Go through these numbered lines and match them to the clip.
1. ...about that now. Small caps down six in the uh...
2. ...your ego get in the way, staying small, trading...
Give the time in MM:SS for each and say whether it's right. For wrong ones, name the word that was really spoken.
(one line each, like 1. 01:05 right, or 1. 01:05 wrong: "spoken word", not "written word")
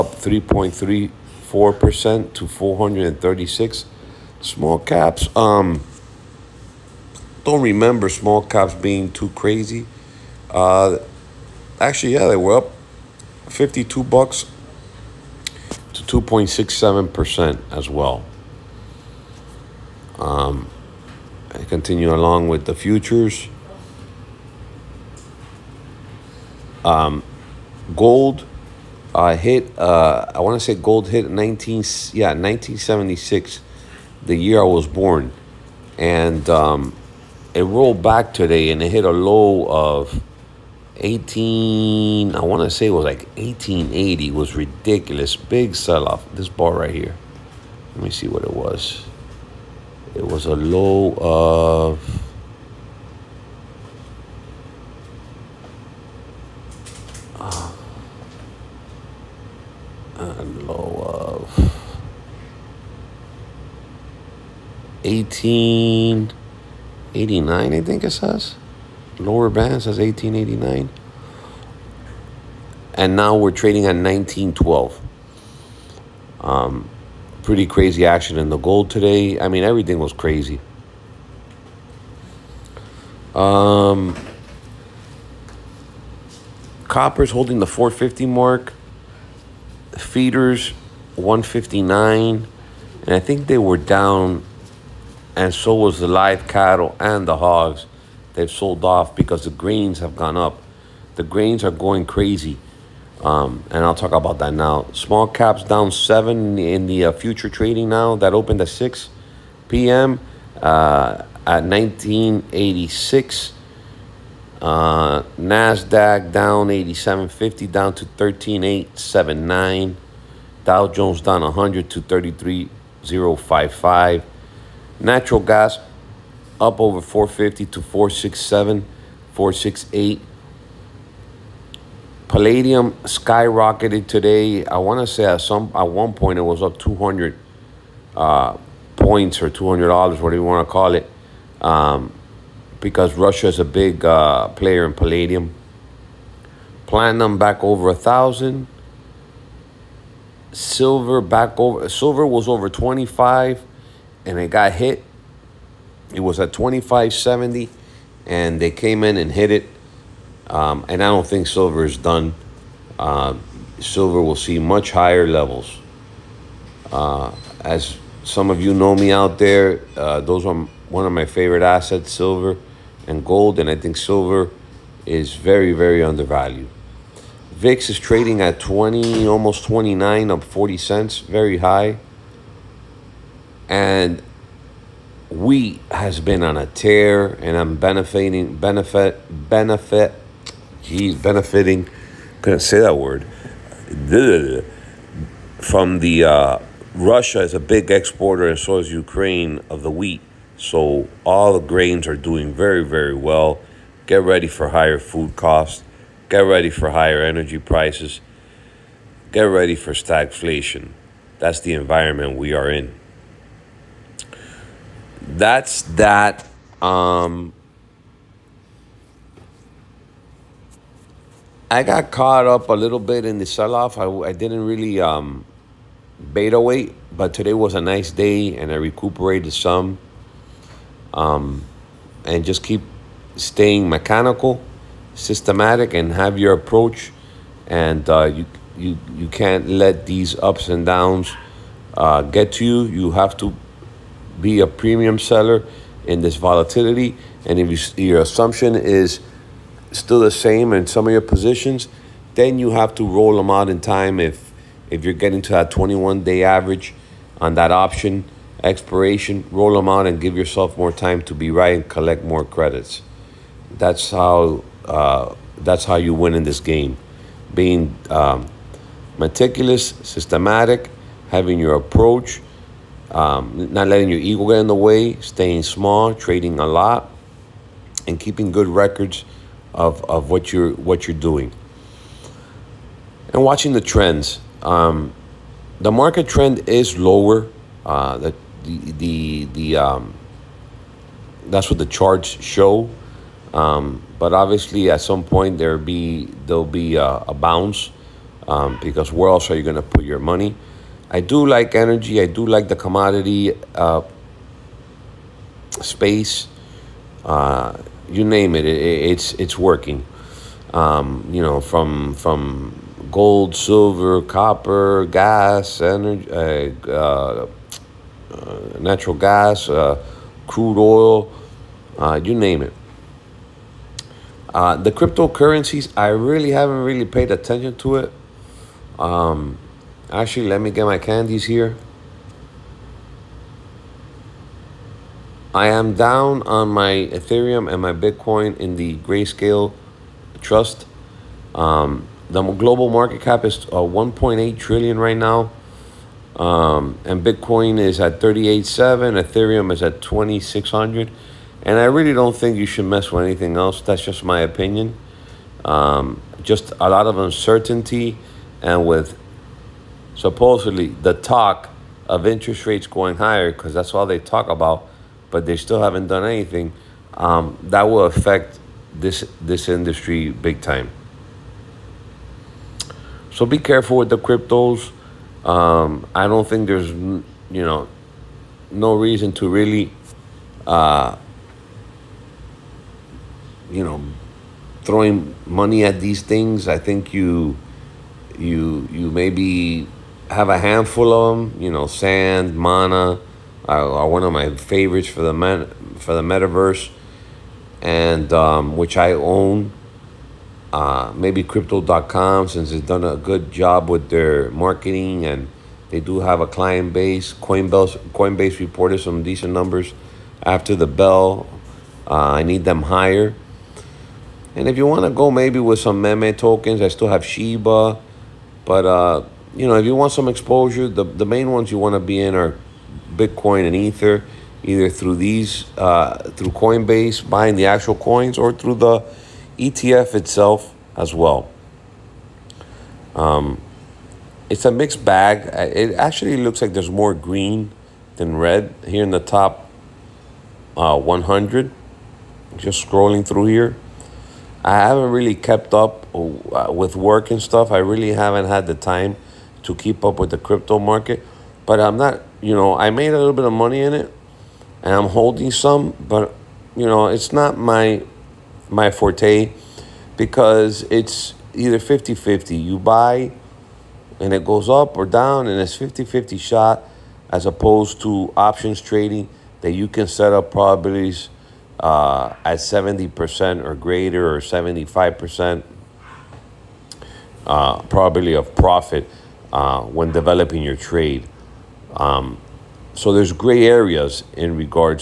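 1. 01:44 wrong: "seven", not "six"
2. 04:34 right.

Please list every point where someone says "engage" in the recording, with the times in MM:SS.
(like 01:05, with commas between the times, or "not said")
not said.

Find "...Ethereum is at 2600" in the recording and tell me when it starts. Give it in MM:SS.
05:49.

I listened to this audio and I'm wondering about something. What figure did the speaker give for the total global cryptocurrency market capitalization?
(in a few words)
1.8 trillion.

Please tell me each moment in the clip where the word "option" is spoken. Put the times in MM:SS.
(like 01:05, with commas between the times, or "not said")
04:17, 07:48.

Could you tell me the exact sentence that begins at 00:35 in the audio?
And um, it rolled back today and it hit a low of 18, I want to say it was like 1880.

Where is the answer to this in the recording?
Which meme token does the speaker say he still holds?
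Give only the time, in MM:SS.
06:57.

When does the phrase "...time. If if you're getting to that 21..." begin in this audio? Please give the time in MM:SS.
04:13.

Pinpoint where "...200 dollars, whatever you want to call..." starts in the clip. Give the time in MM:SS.
02:19.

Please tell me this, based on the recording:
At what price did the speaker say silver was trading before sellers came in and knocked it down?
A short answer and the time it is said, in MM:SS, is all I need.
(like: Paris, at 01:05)
25.70, at 02:36.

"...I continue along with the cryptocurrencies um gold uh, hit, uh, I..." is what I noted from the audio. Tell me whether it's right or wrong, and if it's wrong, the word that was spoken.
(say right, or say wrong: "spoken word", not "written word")
wrong: "futures", not "cryptocurrencies".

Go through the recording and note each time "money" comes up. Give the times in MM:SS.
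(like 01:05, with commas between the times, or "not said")
05:00, 06:25, 07:33.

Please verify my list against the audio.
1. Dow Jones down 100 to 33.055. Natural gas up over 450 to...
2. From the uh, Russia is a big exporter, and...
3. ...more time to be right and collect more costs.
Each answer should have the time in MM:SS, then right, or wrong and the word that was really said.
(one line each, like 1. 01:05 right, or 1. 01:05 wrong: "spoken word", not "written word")
1. 02:00 right
2. 03:15 right
3. 04:20 wrong: "credits", not "costs".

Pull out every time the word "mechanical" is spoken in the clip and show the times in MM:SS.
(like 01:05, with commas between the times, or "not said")
03:53.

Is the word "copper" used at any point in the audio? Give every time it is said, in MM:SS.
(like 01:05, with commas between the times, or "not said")
01:26, 05:14.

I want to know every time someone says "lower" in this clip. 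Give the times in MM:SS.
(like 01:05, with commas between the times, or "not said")
01:09, 04:46.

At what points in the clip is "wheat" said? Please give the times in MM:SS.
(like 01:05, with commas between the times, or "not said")
03:05, 03:19.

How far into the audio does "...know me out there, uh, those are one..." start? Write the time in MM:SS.
02:48.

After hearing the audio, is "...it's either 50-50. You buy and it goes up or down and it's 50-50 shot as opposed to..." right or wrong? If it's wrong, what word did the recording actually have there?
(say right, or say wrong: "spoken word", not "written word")
right.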